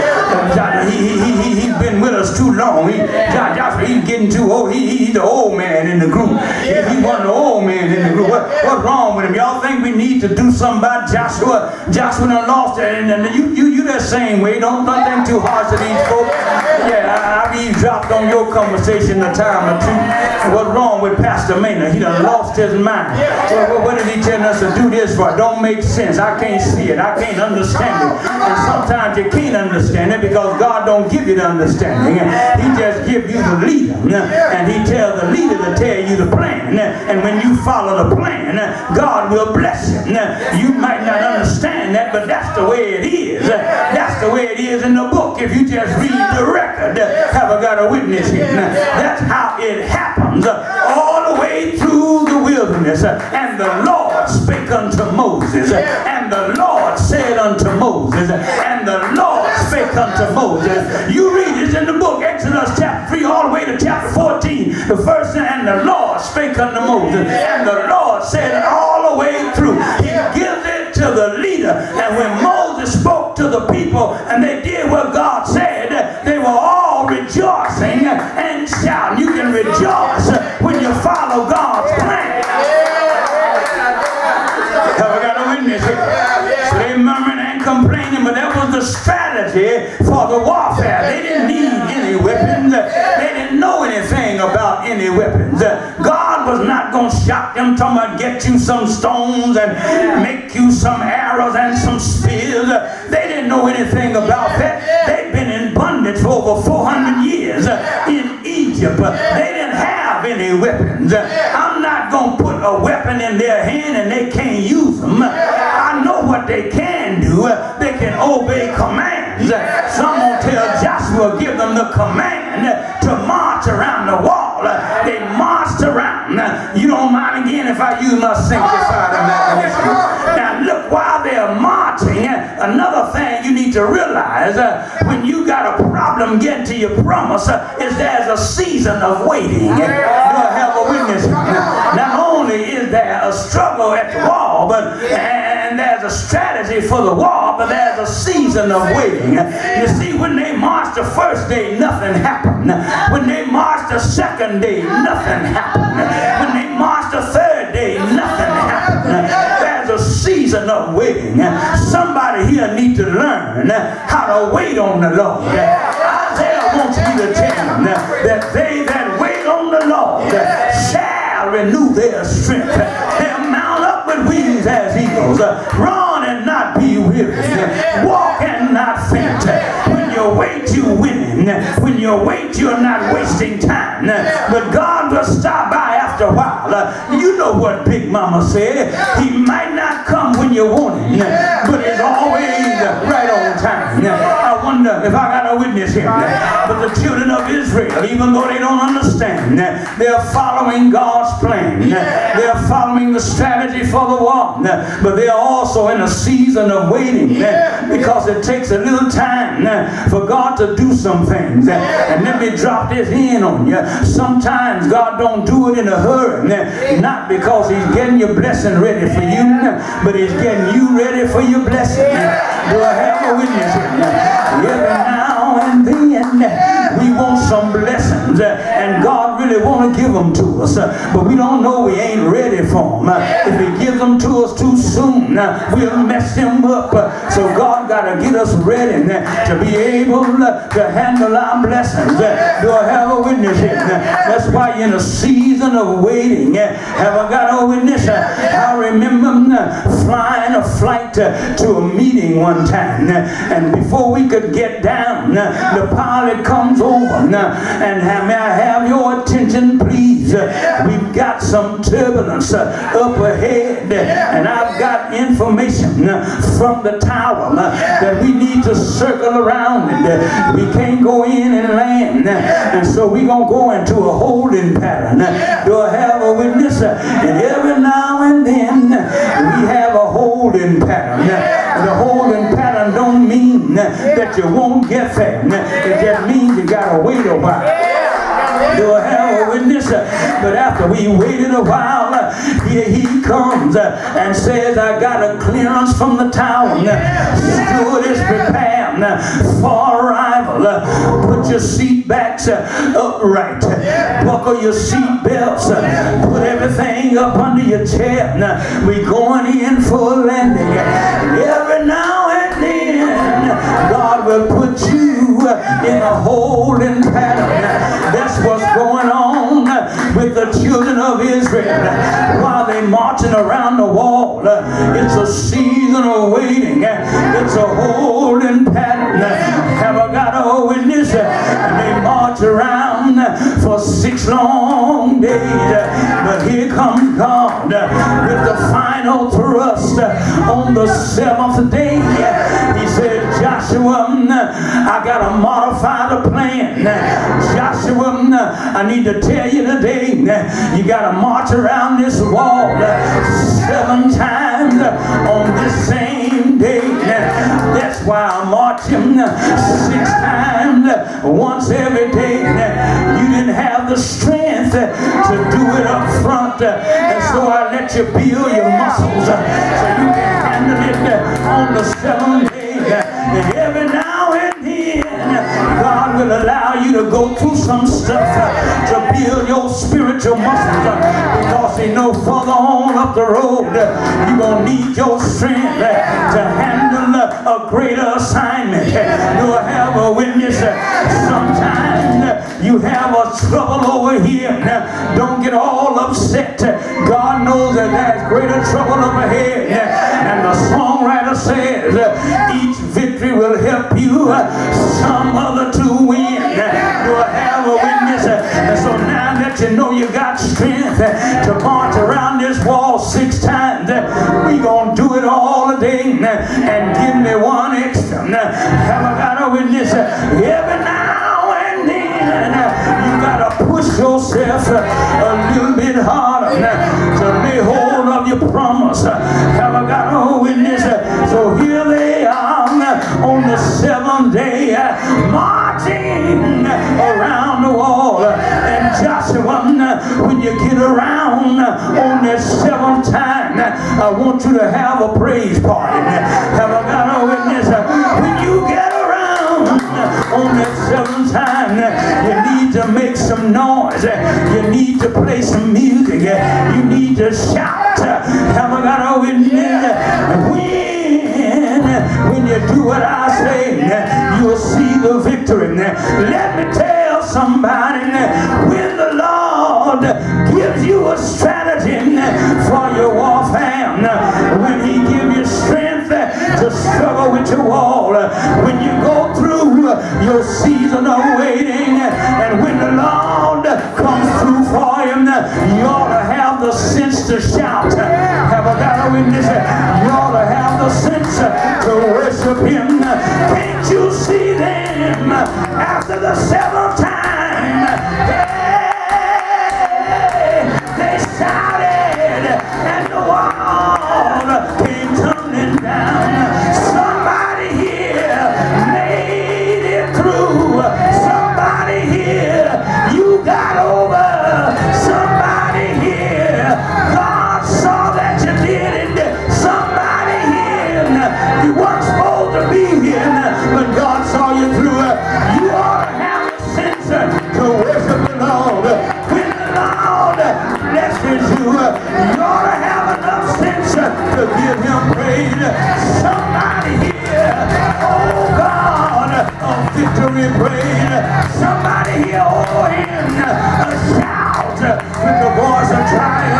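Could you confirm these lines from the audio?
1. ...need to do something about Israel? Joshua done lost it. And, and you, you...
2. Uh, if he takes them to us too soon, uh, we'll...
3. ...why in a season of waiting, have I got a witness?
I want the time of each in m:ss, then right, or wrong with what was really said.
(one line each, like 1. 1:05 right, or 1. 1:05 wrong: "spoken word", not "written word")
1. 0:09 wrong: "Joshua", not "Israel"
2. 3:53 wrong: "gives", not "takes"
3. 4:04 right.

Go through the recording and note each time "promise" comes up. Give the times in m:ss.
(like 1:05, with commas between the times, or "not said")
2:17.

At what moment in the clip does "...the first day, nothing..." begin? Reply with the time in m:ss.
2:30.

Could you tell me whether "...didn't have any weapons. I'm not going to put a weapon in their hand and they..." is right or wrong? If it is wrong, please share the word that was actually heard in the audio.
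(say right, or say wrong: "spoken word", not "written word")
right.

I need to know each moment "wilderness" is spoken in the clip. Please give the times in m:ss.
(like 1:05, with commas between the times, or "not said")
0:52.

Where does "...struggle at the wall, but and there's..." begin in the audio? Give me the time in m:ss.
2:23.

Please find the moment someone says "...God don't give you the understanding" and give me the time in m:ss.
0:30.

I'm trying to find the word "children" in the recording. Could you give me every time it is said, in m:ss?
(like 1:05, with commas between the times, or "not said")
3:17, 5:20.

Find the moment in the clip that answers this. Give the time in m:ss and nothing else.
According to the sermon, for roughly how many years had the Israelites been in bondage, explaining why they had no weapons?
1:46.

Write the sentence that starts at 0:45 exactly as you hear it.
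If you just read the record, have I got a witness here?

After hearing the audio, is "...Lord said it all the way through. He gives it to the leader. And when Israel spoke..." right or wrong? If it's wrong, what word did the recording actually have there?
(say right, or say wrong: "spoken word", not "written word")
wrong: "Moses", not "Israel".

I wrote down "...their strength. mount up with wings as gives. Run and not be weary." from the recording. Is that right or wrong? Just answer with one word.
wrong.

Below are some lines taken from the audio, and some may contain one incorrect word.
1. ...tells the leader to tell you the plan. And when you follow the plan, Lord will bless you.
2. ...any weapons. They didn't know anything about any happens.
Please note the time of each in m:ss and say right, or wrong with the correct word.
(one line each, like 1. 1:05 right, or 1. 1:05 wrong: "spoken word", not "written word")
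1. 0:34 wrong: "God", not "Lord"
2. 1:31 wrong: "weapons", not "happens".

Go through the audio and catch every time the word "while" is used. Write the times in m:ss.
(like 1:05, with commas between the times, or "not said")
2:10, 3:06, 4:47, 4:51, 5:22.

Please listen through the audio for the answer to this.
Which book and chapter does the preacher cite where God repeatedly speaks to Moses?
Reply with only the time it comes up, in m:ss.
1:02.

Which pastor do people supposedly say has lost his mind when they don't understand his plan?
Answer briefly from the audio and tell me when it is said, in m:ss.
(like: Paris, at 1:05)
Pastor Maynard, at 0:21.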